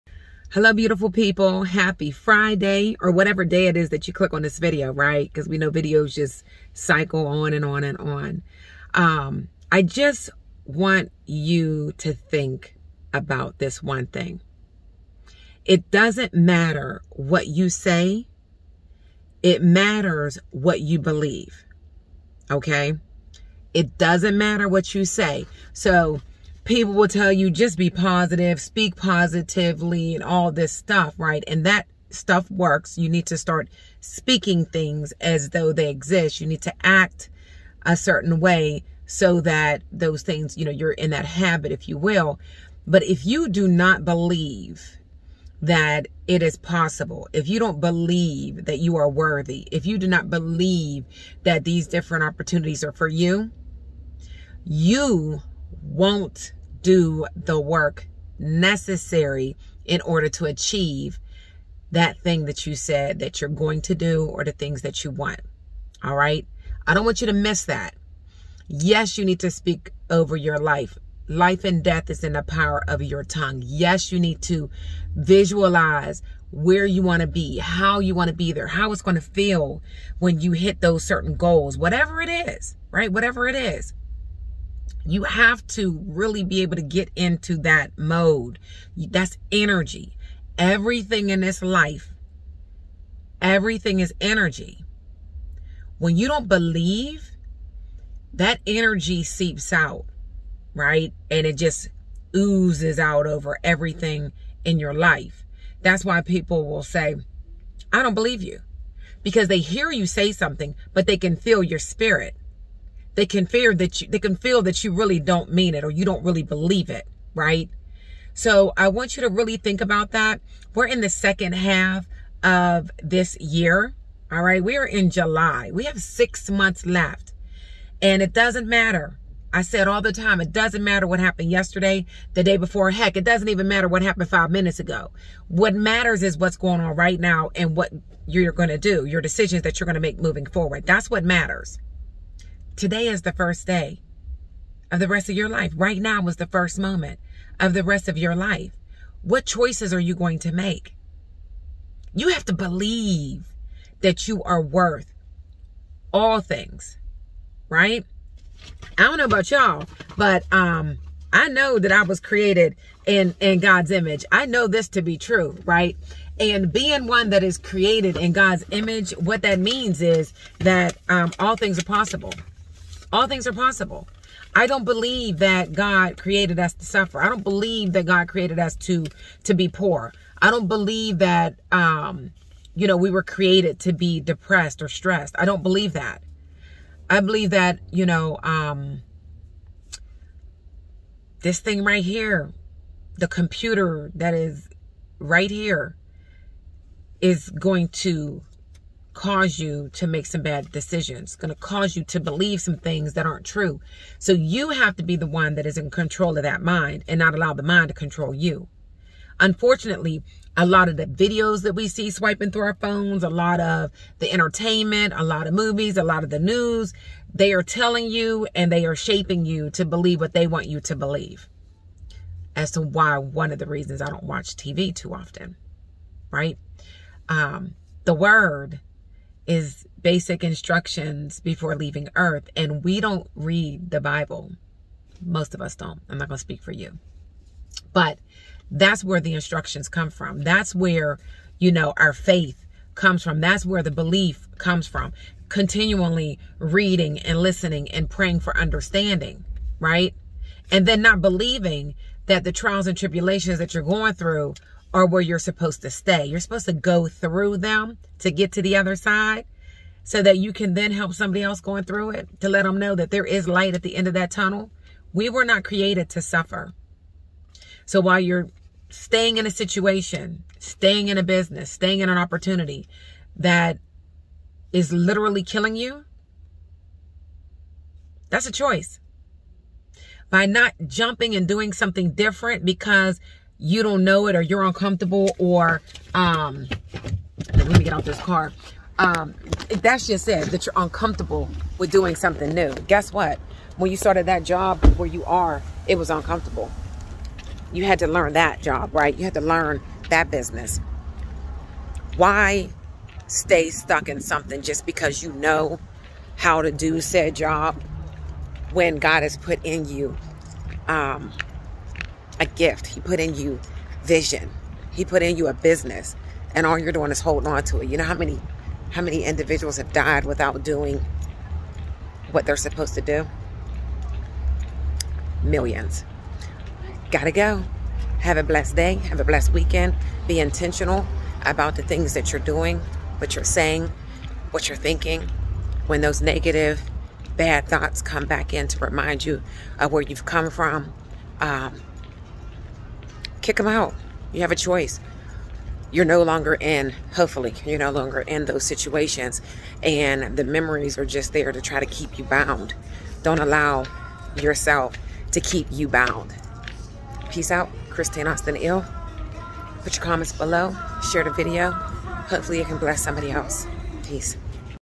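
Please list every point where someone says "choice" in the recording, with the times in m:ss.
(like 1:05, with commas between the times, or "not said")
2:29, 4:38, 5:44.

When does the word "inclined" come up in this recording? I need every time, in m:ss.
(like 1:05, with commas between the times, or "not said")
not said.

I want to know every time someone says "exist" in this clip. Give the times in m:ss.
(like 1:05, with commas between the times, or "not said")
0:35.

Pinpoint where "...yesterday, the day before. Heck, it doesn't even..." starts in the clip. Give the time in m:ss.
2:11.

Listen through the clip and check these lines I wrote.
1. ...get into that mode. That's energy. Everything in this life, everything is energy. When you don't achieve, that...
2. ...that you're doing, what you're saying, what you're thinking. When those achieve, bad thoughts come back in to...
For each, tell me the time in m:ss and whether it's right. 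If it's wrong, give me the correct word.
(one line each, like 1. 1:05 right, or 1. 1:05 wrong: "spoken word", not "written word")
1. 1:26 wrong: "believe", not "achieve"
2. 5:32 wrong: "negative", not "achieve".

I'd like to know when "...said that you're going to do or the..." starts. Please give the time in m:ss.
1:02.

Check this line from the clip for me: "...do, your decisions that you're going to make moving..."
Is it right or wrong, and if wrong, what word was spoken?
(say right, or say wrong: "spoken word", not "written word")
right.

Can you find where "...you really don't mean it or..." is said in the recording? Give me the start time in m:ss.
1:54.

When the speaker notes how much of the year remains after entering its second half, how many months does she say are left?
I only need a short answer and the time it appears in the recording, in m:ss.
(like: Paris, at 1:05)
6, at 2:06.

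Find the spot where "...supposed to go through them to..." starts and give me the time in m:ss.
4:16.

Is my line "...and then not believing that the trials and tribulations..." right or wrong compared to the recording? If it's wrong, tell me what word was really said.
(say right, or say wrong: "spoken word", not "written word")
right.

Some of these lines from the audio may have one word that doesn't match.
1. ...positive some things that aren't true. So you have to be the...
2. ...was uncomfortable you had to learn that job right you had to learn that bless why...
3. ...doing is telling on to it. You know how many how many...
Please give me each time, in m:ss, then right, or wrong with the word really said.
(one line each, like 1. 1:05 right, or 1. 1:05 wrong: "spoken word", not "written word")
1. 3:22 wrong: "believe", not "positive"
2. 4:55 wrong: "business", not "bless"
3. 5:16 wrong: "holding", not "telling".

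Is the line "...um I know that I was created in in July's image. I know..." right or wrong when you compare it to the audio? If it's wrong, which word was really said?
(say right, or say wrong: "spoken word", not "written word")
wrong: "God", not "July".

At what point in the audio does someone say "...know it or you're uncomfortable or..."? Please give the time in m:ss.
4:44.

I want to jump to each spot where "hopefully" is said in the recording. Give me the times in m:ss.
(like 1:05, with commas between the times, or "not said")
5:47, 6:01.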